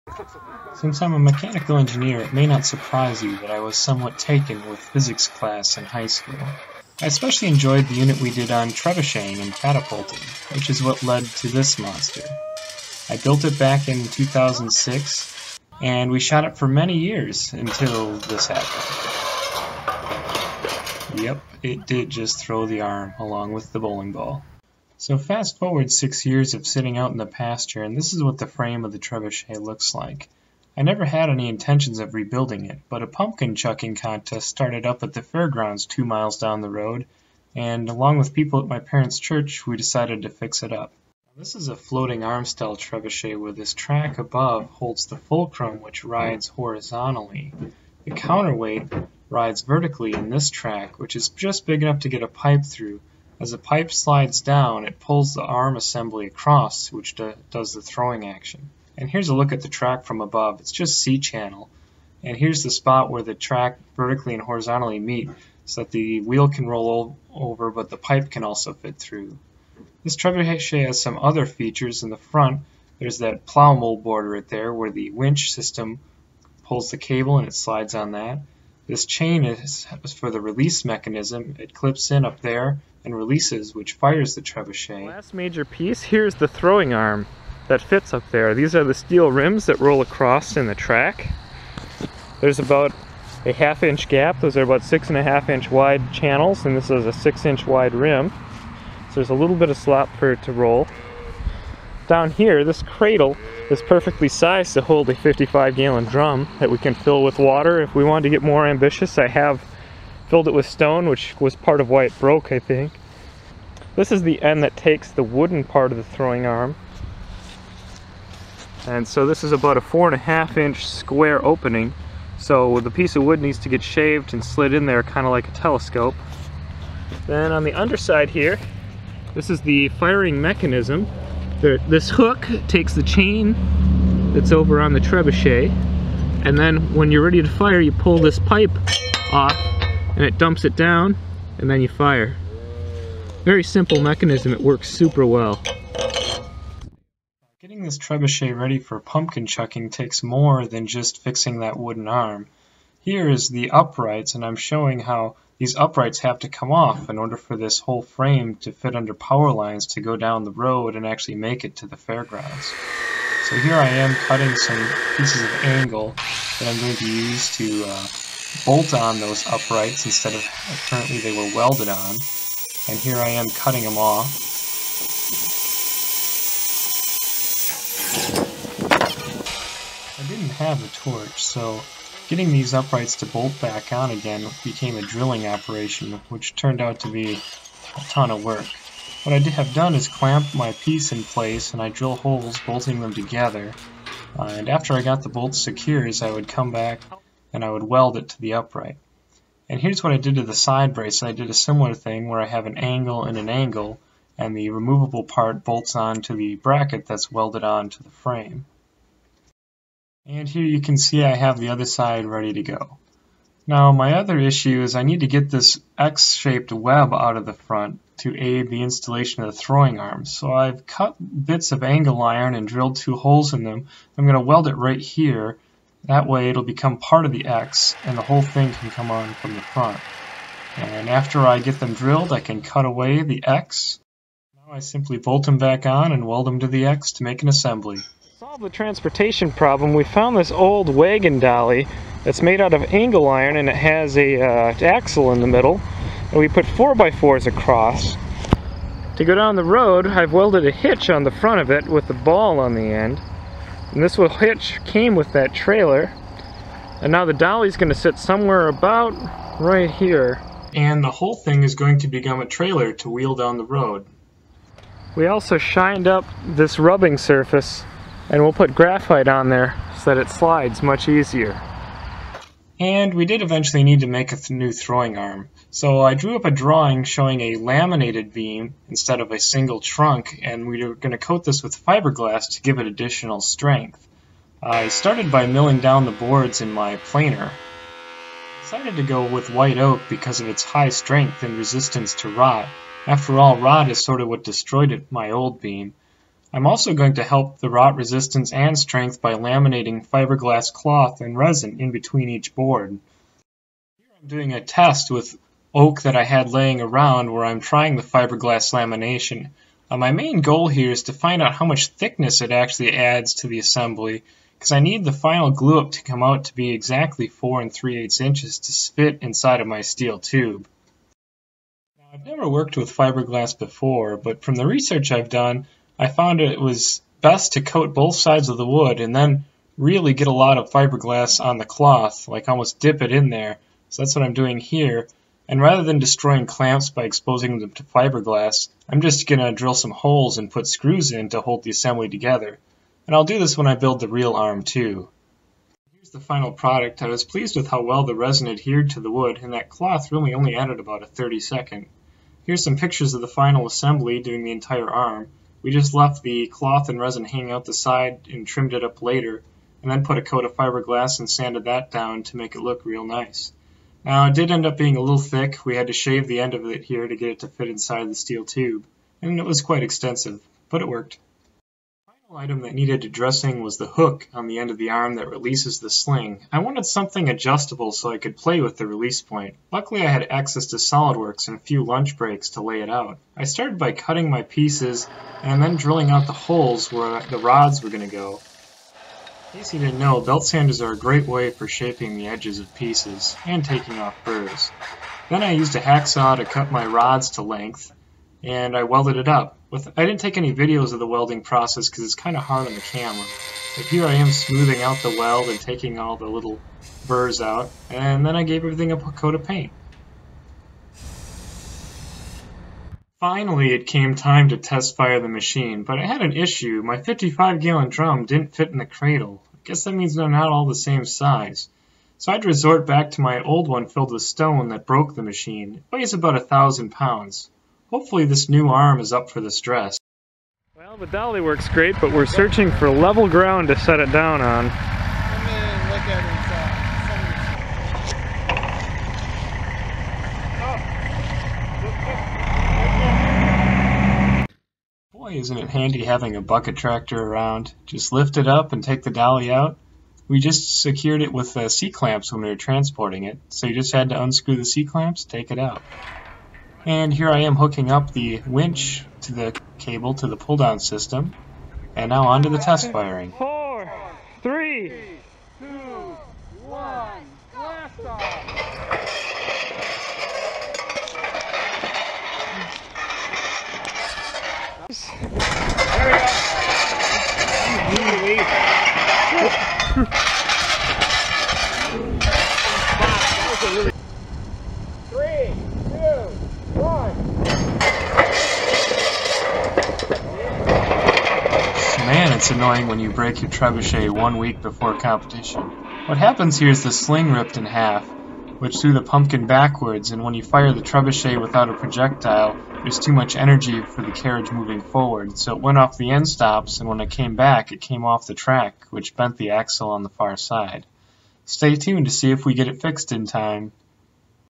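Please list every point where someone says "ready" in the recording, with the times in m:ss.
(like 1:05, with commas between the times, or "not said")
2:17, 2:28, 3:32.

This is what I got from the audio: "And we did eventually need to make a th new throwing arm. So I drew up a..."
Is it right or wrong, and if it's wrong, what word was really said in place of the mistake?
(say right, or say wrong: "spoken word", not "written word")
right.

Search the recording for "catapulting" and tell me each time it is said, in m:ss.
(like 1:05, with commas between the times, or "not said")
0:09.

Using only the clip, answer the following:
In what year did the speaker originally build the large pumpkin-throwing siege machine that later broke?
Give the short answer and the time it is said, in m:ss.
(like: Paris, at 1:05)
2006, at 0:14.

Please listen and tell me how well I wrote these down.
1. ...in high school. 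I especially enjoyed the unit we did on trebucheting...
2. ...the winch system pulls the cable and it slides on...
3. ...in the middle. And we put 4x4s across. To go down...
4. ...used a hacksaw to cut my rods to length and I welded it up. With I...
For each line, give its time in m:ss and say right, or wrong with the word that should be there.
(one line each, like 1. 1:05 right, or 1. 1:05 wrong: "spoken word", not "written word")
1. 0:05 right
2. 1:14 right
3. 4:05 right
4. 6:35 right.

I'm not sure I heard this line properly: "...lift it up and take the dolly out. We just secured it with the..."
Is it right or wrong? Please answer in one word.
right.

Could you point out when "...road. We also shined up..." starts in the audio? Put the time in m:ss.
4:23.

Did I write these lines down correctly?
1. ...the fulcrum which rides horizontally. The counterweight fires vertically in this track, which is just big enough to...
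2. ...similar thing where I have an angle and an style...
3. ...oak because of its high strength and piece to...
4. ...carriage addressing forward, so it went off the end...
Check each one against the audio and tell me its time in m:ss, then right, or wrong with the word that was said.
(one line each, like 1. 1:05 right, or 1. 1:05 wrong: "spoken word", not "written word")
1. 0:45 wrong: "rides", not "fires"
2. 3:21 wrong: "angle", not "style"
3. 4:49 wrong: "resistance", not "piece"
4. 8:24 wrong: "moving", not "addressing".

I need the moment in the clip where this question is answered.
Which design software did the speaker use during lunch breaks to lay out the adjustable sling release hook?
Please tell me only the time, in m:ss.
6:20.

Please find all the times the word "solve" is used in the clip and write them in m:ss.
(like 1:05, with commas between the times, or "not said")
3:58.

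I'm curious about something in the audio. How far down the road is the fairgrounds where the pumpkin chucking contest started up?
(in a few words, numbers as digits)
2 miles.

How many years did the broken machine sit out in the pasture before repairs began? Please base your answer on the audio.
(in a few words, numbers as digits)
6.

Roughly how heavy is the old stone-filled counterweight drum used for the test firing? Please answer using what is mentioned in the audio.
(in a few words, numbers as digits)
1000 pounds.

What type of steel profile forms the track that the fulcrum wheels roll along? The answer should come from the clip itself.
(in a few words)
C-channel.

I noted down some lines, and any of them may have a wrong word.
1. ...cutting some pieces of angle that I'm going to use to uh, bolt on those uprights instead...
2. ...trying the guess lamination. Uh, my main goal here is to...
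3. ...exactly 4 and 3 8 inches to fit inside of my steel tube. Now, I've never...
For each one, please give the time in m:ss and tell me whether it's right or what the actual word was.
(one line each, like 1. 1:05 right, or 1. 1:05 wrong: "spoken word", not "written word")
1. 2:44 right
2. 5:07 wrong: "fiberglass", not "guess"
3. 5:16 right.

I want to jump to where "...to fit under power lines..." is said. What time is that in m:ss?
2:38.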